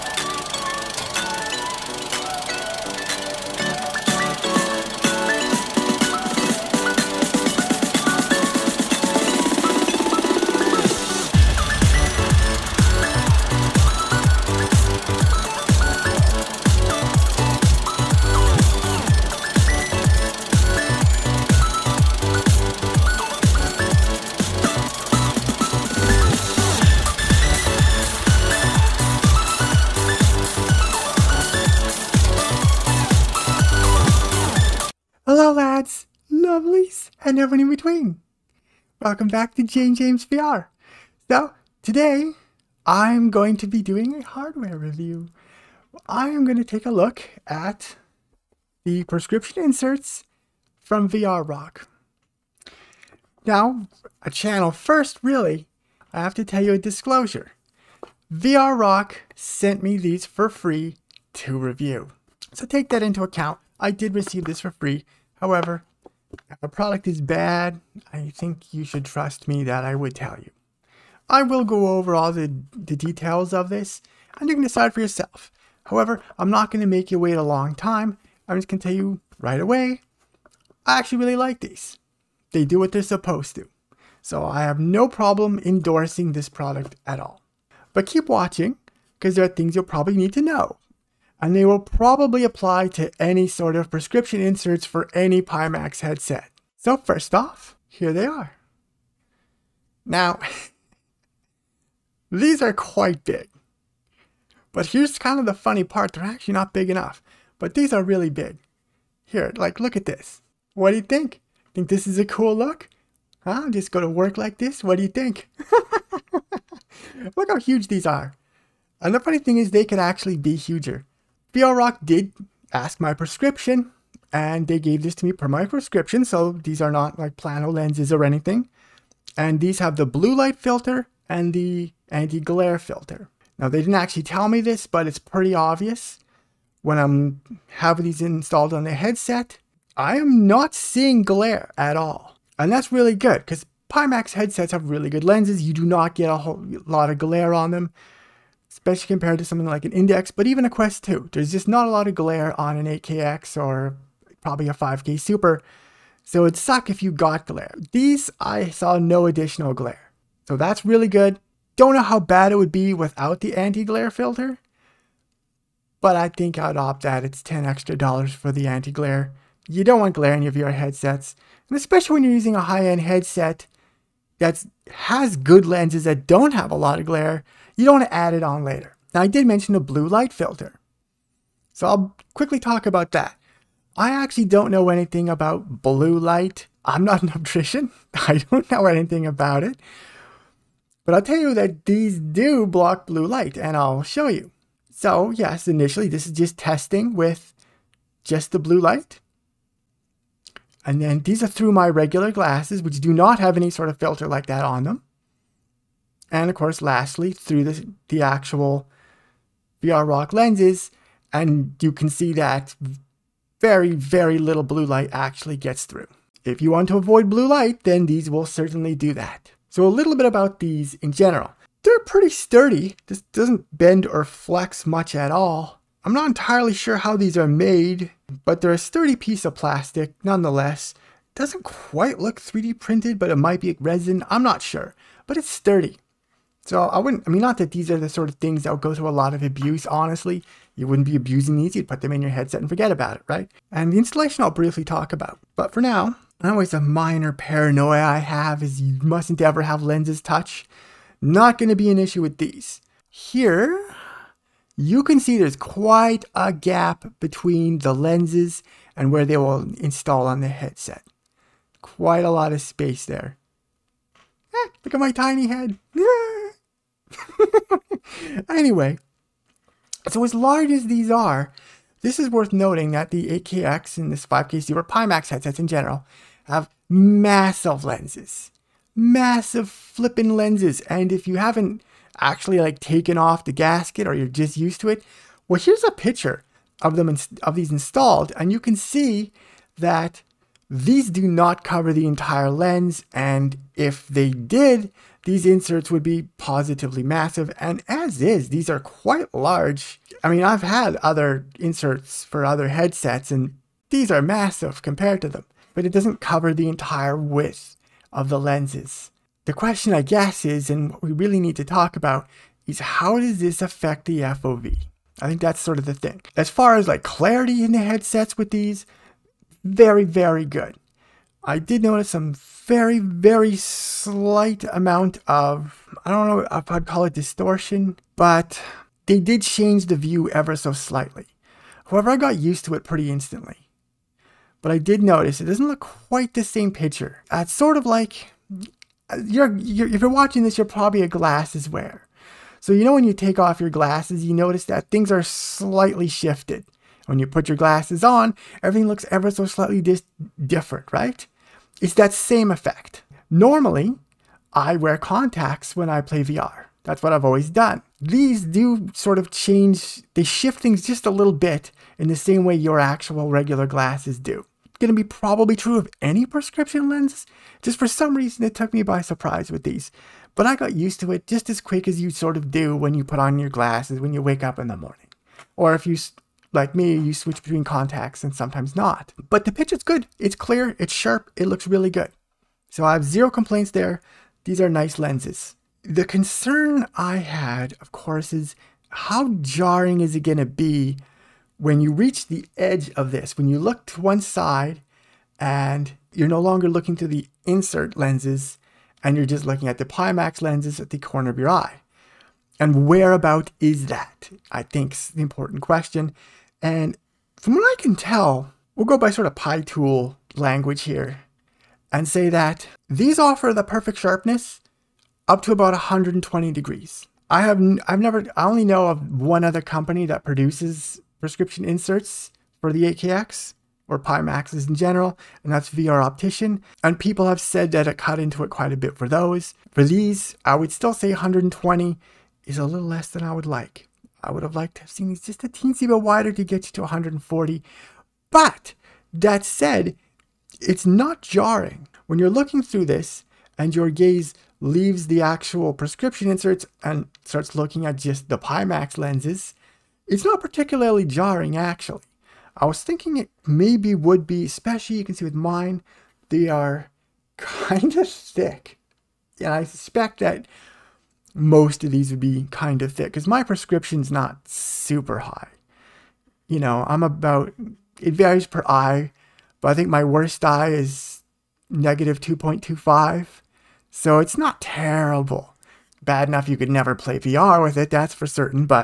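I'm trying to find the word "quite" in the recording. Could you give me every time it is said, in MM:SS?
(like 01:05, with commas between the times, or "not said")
01:42, 03:51, 04:15, 04:21, 04:58, 05:35, 07:08.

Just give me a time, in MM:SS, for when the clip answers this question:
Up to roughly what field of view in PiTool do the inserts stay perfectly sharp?
06:55.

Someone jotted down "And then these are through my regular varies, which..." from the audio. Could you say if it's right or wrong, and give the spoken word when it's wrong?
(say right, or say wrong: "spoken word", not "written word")
wrong: "glasses", not "varies".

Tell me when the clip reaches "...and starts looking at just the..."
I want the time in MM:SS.
07:26.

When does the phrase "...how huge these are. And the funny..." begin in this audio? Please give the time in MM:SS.
01:57.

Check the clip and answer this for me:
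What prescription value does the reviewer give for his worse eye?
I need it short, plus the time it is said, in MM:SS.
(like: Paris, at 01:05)
-2.25, at 07:51.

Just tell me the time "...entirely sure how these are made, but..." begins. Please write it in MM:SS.
03:46.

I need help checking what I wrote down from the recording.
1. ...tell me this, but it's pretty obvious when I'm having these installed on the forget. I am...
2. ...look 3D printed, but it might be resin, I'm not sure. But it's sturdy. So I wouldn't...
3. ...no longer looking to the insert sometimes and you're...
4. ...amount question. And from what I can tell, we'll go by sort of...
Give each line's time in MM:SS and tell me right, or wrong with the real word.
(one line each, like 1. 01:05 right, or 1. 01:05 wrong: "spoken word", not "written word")
1. 02:14 wrong: "headset", not "forget"
2. 03:52 right
3. 06:36 wrong: "lenses", not "sometimes"
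4. 06:45 wrong: "important", not "amount".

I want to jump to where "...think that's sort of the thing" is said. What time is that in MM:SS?
05:15.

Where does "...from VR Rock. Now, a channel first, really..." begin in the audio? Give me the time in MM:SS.
00:50.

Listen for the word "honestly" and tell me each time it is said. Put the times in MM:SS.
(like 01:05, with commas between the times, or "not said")
03:59.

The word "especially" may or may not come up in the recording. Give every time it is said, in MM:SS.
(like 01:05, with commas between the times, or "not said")
02:28, 02:51, 07:34.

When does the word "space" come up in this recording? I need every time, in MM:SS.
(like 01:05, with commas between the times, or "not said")
04:22.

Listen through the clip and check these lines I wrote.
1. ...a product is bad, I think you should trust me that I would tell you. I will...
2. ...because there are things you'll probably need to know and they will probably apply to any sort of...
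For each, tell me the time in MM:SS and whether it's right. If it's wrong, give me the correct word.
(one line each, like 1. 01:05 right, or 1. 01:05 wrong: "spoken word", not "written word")
1. 01:06 right
2. 01:29 right.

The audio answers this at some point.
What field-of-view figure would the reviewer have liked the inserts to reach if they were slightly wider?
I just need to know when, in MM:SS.
07:16.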